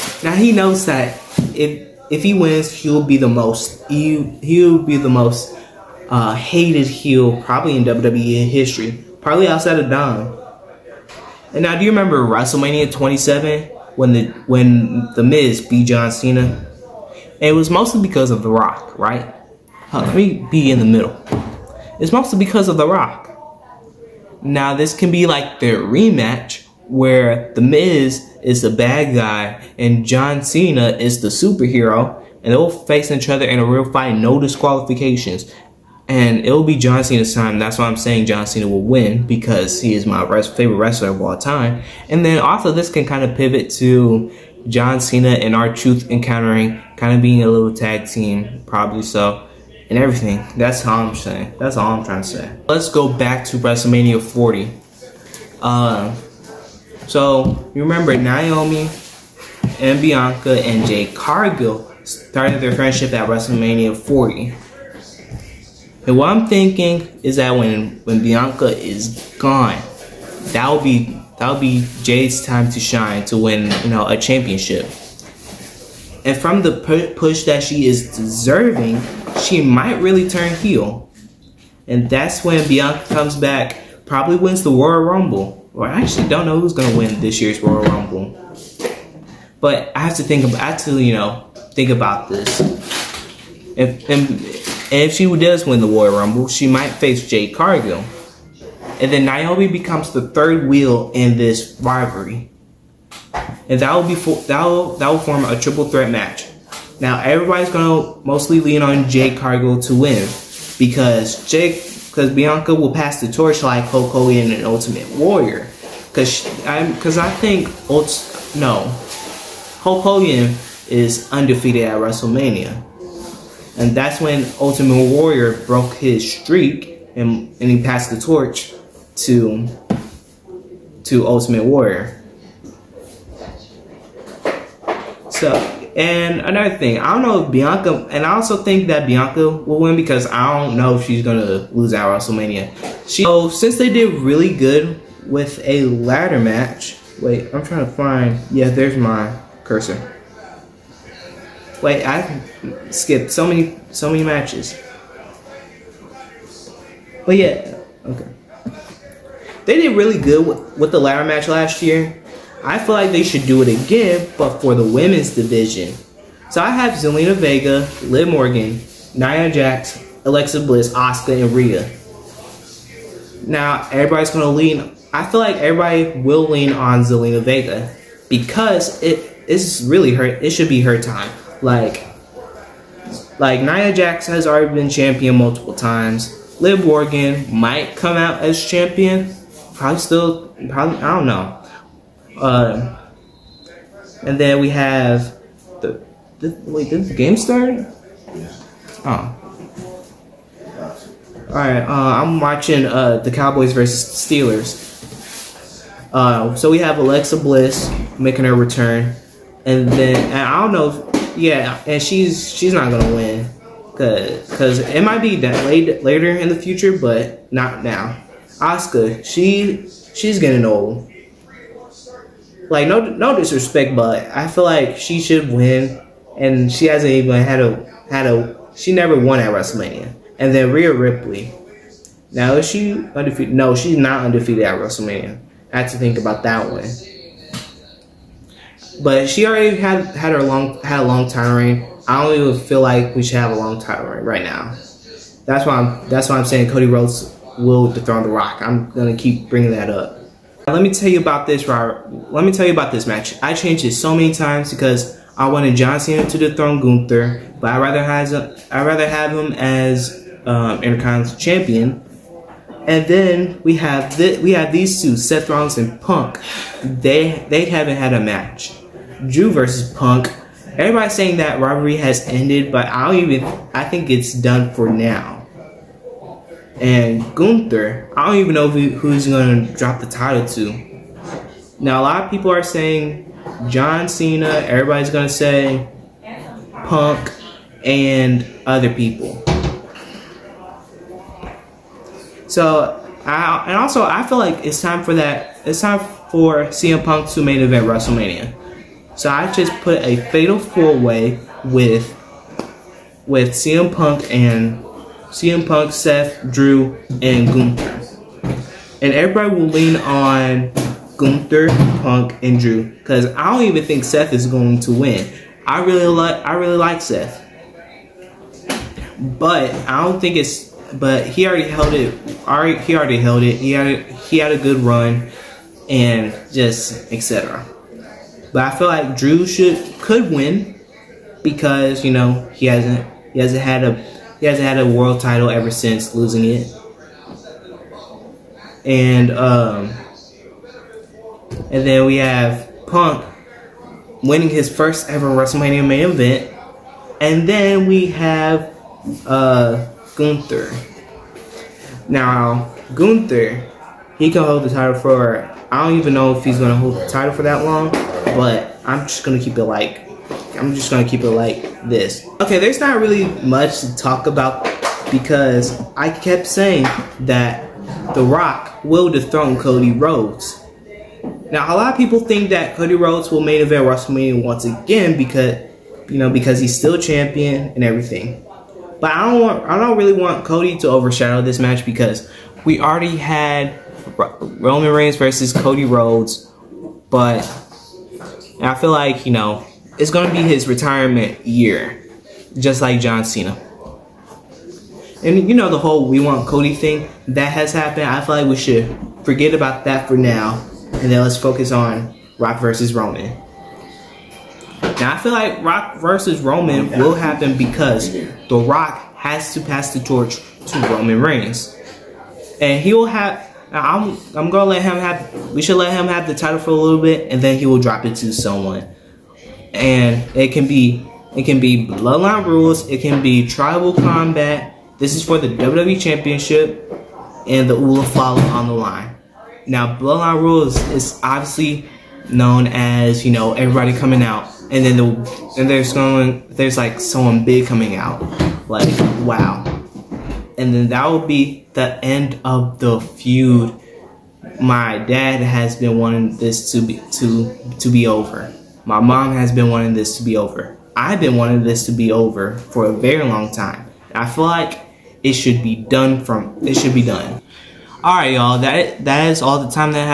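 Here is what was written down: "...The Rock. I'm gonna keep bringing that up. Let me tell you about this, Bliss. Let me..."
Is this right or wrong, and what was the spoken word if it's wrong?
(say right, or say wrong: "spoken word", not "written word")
wrong: "Robert", not "Bliss".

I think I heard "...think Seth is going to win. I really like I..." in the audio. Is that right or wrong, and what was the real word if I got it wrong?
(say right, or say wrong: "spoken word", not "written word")
right.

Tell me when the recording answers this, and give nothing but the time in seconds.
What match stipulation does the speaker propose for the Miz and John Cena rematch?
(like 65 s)
34 s.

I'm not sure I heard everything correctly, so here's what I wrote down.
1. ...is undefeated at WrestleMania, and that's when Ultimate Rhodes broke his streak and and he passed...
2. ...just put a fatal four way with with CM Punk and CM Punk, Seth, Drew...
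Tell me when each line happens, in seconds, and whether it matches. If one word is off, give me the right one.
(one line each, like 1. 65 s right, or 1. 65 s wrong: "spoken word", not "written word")
1. 120 s wrong: "Warrior", not "Rhodes"
2. 299 s right.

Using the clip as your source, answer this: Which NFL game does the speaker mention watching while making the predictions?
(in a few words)
Cowboys versus Steelers.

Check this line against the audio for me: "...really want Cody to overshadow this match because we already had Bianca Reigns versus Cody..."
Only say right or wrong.
wrong.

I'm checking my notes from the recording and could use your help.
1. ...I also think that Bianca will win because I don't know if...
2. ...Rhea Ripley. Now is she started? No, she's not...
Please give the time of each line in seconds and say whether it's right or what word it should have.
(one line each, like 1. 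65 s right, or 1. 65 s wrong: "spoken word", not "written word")
1. 138 s right
2. 230 s wrong: "undefeated", not "started".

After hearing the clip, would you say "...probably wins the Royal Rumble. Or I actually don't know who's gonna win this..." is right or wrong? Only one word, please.
right.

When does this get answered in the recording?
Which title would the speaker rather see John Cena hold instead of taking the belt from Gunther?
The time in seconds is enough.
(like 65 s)
260 s.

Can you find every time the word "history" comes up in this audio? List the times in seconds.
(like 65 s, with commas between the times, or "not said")
8 s.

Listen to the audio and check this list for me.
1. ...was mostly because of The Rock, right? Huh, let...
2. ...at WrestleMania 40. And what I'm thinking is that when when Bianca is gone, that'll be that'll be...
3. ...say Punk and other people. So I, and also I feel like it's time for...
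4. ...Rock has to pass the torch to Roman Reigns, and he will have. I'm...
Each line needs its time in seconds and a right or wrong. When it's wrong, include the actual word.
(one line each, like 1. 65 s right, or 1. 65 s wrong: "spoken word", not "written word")
1. 17 s right
2. 63 s right
3. 285 s right
4. 408 s right.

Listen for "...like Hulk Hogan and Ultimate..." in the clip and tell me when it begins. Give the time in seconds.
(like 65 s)
113 s.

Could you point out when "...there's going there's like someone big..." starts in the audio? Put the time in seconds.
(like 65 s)
435 s.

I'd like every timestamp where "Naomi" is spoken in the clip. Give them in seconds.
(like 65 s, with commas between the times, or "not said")
58 s, 99 s.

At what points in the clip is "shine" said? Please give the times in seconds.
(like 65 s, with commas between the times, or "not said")
72 s.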